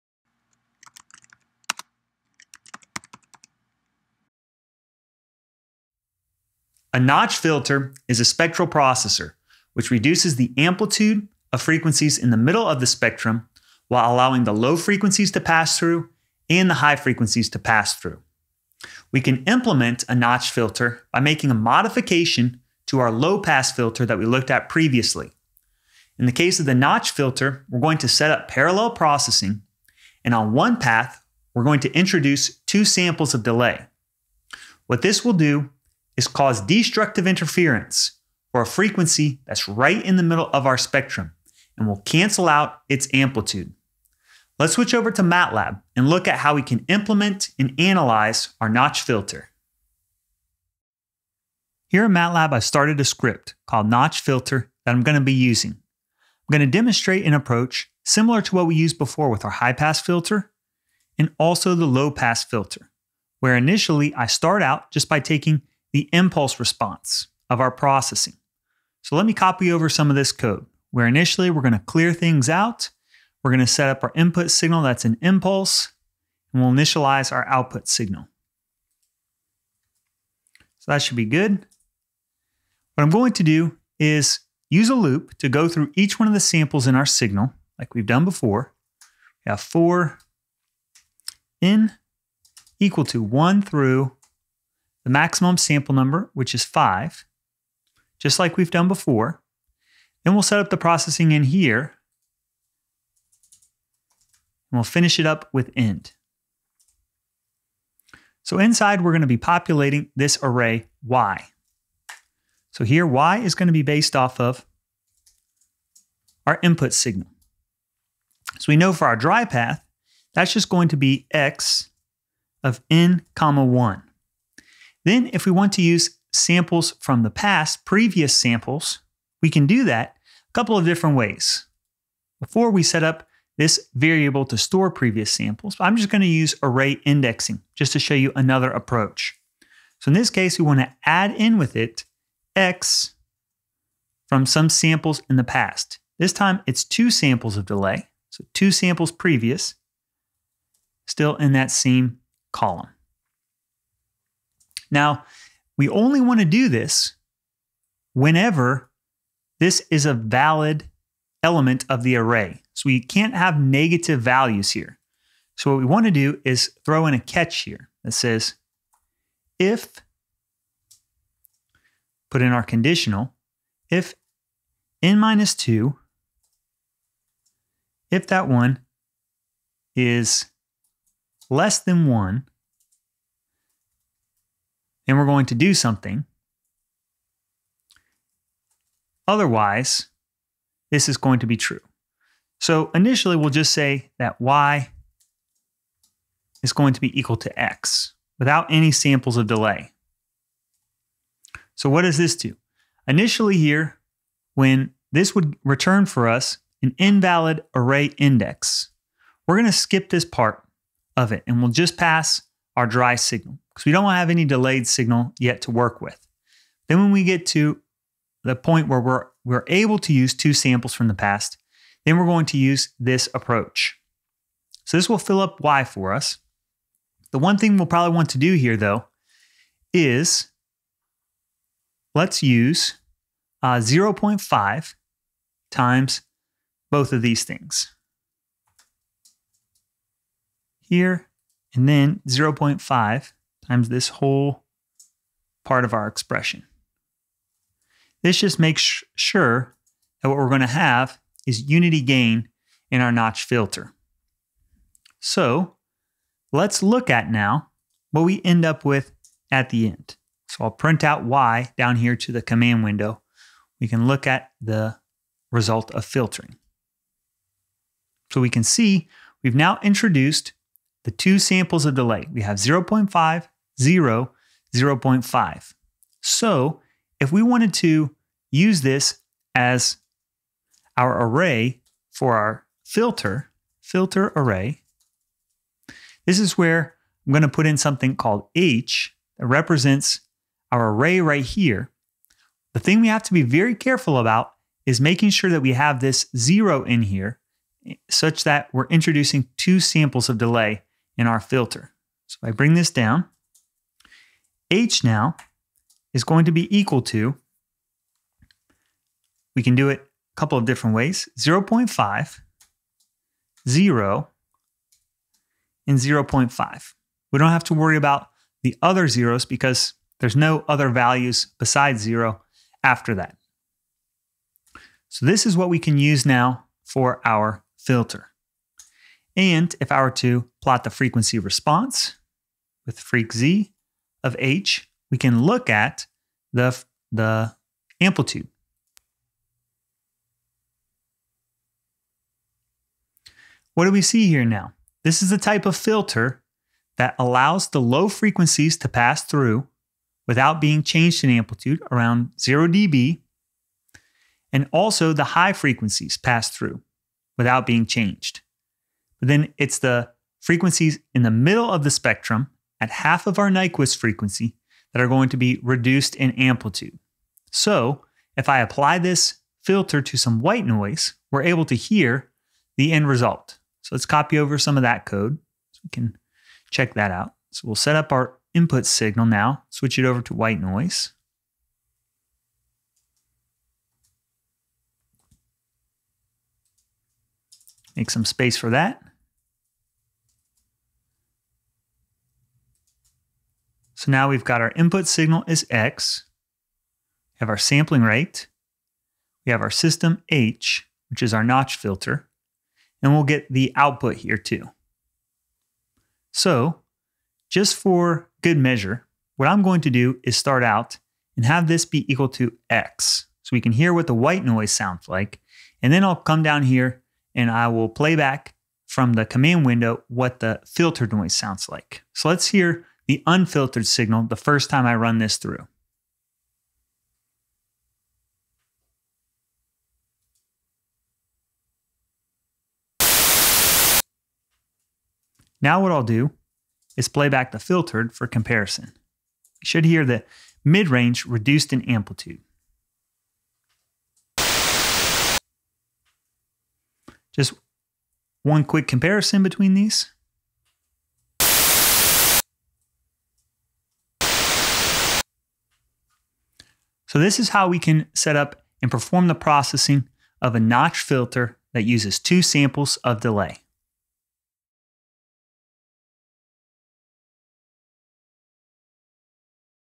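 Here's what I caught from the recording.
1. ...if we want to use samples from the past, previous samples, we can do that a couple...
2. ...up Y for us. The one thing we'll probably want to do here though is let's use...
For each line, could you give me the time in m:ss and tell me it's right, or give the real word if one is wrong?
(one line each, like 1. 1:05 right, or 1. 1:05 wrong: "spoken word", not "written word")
1. 2:05 right
2. 3:45 right.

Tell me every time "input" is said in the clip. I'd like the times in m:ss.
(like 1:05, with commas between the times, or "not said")
1:14, 1:56, 6:18, 6:34.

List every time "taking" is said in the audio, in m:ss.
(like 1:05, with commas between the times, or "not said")
1:05.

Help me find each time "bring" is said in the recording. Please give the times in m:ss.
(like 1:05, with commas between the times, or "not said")
5:02.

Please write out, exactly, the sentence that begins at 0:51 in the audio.
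Here in MATLAB, I started a script called notch filter that I'm going to be using.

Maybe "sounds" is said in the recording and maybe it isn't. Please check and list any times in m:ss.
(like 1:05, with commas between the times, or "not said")
6:54, 7:01.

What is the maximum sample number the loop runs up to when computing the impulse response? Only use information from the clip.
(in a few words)
5.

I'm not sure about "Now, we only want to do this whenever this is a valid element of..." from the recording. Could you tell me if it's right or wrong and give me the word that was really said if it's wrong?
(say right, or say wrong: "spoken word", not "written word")
right.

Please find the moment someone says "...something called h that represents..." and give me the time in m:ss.
4:47.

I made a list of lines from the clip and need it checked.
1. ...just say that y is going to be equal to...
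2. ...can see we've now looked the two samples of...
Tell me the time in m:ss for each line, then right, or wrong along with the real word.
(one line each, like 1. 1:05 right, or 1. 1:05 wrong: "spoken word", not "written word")
1. 3:13 right
2. 4:28 wrong: "introduced", not "looked".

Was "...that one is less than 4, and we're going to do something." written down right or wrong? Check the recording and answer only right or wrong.
wrong.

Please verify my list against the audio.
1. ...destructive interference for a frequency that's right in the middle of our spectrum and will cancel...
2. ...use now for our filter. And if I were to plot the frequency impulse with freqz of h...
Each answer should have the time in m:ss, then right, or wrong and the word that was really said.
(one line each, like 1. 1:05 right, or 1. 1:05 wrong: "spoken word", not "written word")
1. 0:36 right
2. 5:25 wrong: "response", not "impulse".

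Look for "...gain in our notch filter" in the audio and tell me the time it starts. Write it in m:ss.
4:12.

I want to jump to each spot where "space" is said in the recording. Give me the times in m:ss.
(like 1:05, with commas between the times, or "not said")
6:28.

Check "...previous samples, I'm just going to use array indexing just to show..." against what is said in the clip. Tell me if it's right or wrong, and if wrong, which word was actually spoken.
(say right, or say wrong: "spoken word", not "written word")
right.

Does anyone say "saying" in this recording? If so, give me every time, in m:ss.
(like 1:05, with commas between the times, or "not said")
not said.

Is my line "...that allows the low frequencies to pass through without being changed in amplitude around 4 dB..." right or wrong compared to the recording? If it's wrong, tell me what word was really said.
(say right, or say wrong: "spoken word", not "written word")
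wrong: "0", not "4".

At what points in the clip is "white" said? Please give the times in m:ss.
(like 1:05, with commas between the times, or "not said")
6:10, 6:20, 6:54.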